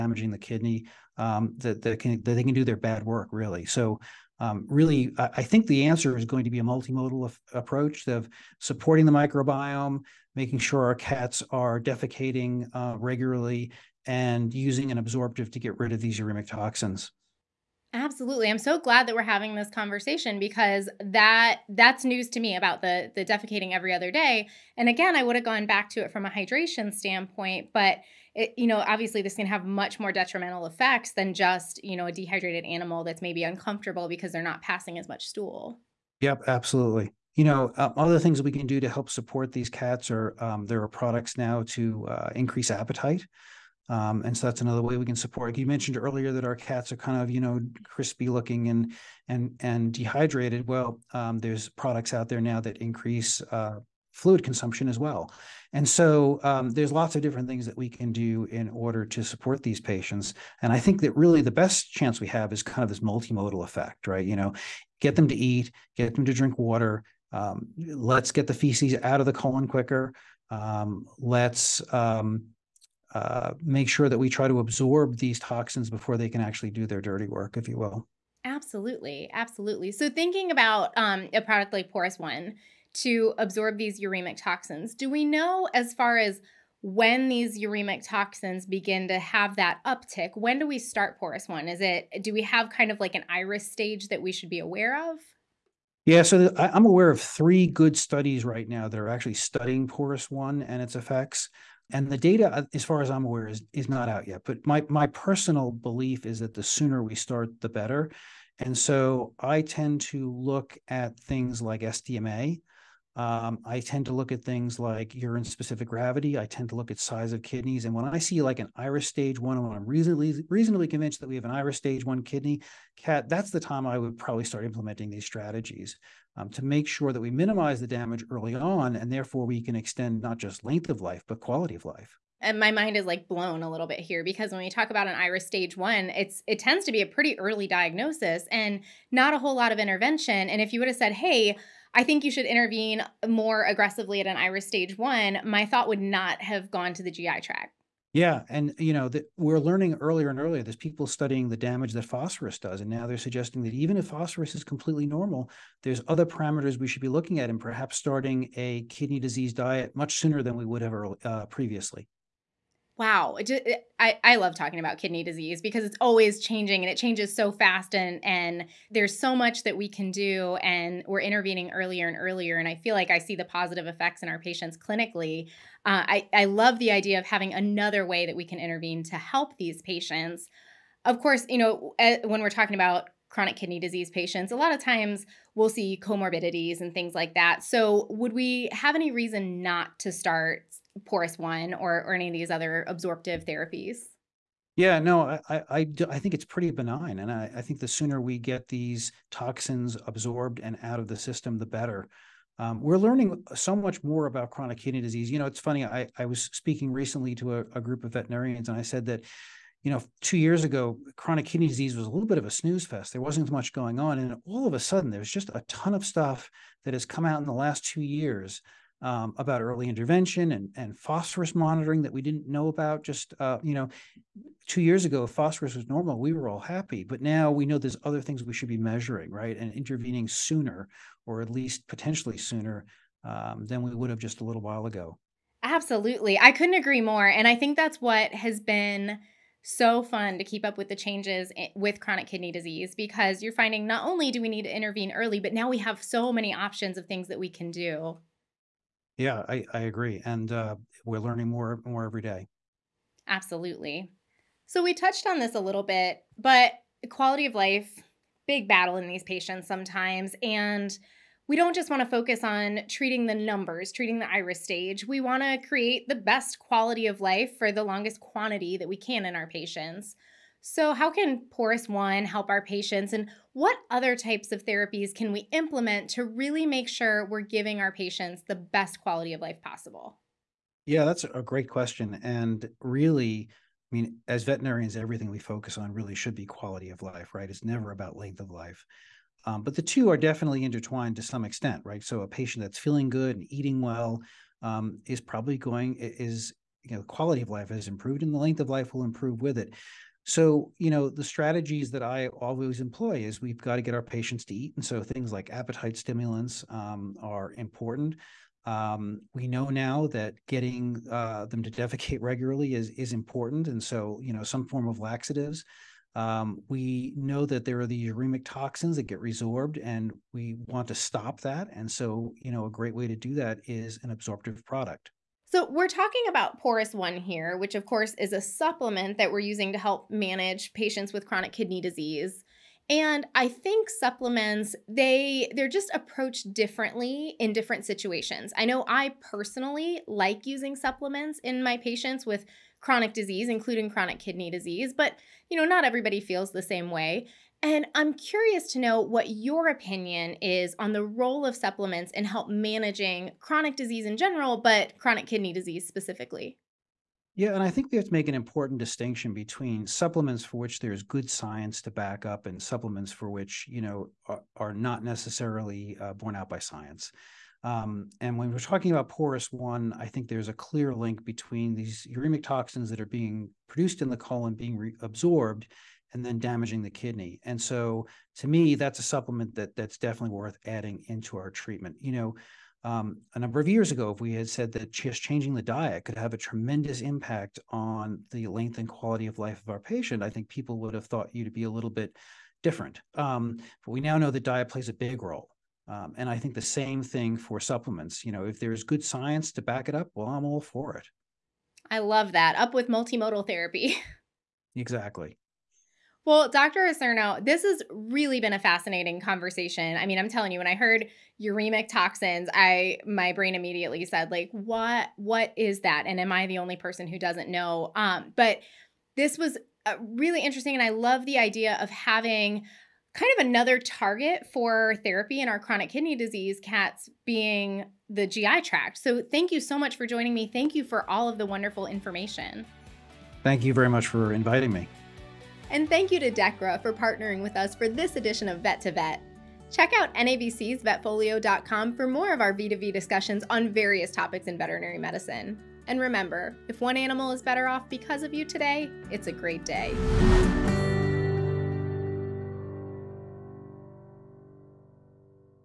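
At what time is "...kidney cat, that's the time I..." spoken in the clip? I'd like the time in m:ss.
2:02.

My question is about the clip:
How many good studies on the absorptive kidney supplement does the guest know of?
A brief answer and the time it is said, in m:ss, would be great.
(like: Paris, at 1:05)
3, at 1:37.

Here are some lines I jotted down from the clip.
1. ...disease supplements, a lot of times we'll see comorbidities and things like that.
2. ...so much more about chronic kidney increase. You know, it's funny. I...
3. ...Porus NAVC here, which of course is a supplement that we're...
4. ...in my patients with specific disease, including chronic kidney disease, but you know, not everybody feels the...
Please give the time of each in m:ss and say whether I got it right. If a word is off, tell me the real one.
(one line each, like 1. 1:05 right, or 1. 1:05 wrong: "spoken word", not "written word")
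1. 3:03 wrong: "patients", not "supplements"
2. 3:23 wrong: "disease", not "increase"
3. 5:26 wrong: "One", not "NAVC"
4. 5:41 wrong: "chronic", not "specific".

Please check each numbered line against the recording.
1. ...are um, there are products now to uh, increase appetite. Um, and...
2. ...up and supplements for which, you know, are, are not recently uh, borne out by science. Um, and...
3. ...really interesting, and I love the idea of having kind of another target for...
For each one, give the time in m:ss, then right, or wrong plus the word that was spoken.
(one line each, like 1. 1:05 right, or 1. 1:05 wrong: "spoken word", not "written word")
1. 0:40 right
2. 6:02 wrong: "necessarily", not "recently"
3. 7:00 right.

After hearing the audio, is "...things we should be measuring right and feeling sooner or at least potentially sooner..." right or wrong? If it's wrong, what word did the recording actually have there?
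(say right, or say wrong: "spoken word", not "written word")
wrong: "intervening", not "feeling".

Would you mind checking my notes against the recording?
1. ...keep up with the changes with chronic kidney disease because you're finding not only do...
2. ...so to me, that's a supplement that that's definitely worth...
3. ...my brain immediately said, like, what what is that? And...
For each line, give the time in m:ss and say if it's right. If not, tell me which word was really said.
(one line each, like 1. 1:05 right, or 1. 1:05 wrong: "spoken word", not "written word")
1. 4:00 right
2. 6:17 right
3. 6:53 right.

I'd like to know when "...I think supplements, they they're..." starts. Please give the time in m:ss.
5:33.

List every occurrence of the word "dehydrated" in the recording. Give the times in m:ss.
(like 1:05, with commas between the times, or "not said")
0:32, 0:49.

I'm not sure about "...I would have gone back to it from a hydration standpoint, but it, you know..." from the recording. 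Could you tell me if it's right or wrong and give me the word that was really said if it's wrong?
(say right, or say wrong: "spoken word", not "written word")
right.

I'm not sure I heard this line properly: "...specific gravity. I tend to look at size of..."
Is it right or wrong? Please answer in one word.
right.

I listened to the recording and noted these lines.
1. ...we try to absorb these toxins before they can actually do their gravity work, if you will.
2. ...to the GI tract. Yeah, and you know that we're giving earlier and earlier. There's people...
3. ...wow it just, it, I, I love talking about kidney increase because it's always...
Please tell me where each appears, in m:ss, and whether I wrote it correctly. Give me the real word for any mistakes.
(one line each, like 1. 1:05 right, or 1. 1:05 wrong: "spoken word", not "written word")
1. 1:14 wrong: "dirty", not "gravity"
2. 2:26 wrong: "learning", not "giving"
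3. 2:42 wrong: "disease", not "increase".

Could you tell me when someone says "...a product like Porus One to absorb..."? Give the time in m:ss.
1:21.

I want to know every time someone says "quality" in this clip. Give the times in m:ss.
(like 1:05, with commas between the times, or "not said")
2:11, 4:17, 4:26, 4:38, 4:46, 4:57, 6:28.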